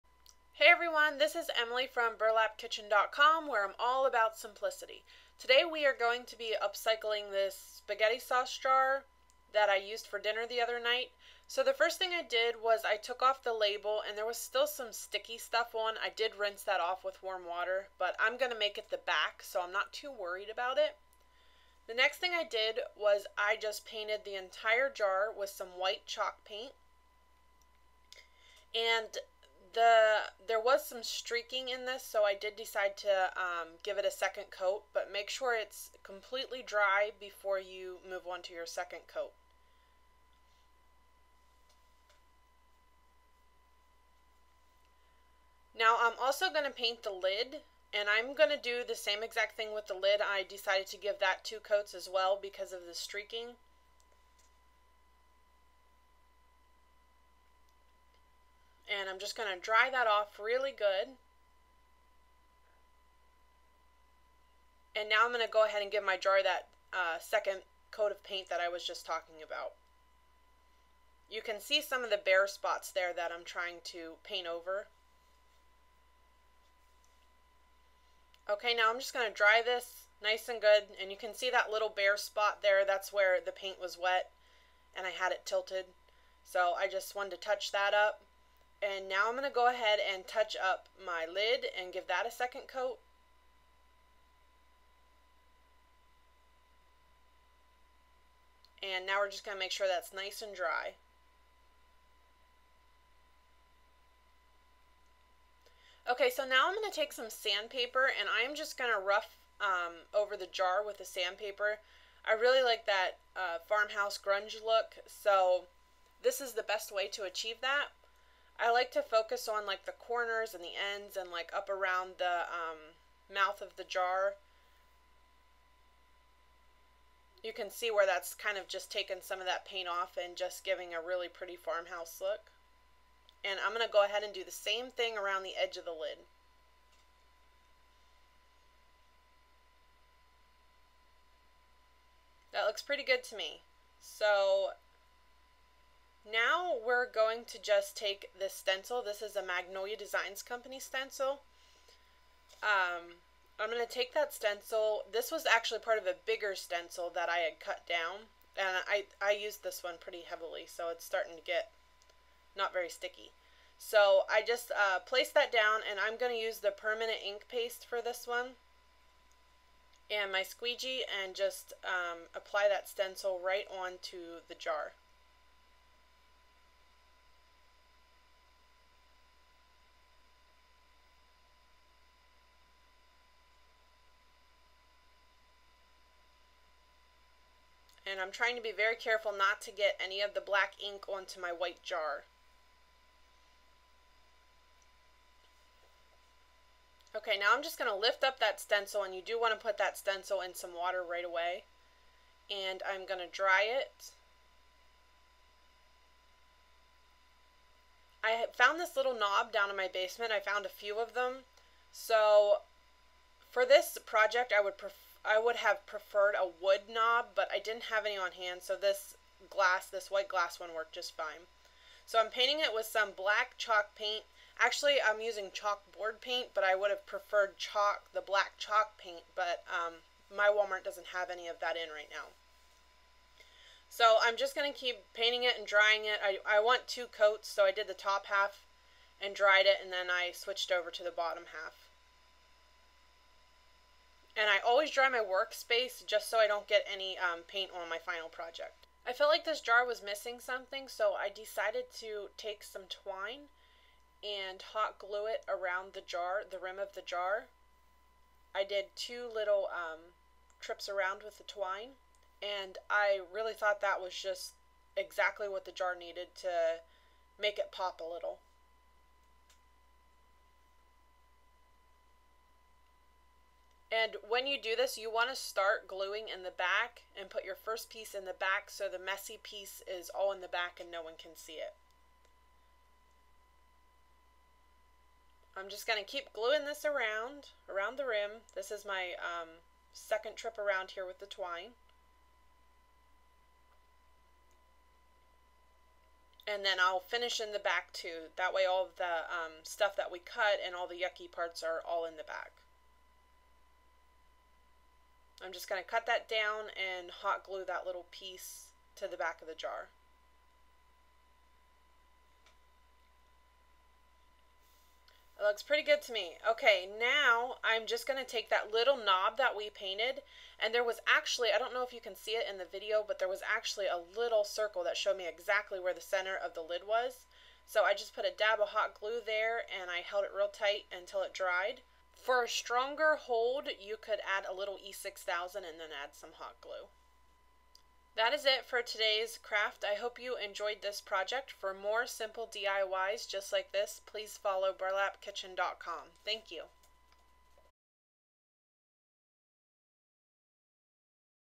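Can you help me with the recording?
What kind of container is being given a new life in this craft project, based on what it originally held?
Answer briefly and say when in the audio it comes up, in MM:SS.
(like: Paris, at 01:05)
Spaghetti sauce jar, at 00:07.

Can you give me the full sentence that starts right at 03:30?
I found a few of them.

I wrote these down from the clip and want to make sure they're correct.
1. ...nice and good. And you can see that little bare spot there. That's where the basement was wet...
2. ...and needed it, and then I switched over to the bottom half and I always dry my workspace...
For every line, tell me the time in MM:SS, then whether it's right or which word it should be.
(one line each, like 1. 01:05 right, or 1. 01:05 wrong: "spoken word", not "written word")
1. 01:20 wrong: "paint", not "basement"
2. 03:59 wrong: "dried", not "needed".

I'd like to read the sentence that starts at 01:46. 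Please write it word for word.
Okay, so now I'm going to take some sandpaper and I'm just going to rough um, over the jar with the sandpaper.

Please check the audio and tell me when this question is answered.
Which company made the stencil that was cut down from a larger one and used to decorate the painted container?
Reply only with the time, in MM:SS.
02:29.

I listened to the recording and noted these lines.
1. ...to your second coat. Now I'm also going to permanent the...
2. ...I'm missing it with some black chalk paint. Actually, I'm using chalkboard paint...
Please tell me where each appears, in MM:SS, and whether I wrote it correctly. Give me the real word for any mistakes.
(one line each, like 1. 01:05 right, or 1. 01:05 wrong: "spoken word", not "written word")
1. 00:38 wrong: "paint", not "permanent"
2. 03:42 wrong: "painting", not "missing".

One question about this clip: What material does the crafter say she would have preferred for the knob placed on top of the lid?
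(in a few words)
Wood.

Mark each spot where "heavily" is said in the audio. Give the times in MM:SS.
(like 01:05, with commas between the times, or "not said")
02:40.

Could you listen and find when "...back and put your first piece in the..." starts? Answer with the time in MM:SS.
04:36.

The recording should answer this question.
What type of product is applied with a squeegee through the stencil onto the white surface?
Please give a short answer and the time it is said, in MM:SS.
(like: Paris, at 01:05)
Permanent ink paste, at 02:46.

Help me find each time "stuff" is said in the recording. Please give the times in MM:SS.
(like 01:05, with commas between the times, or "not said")
00:15, 04:59.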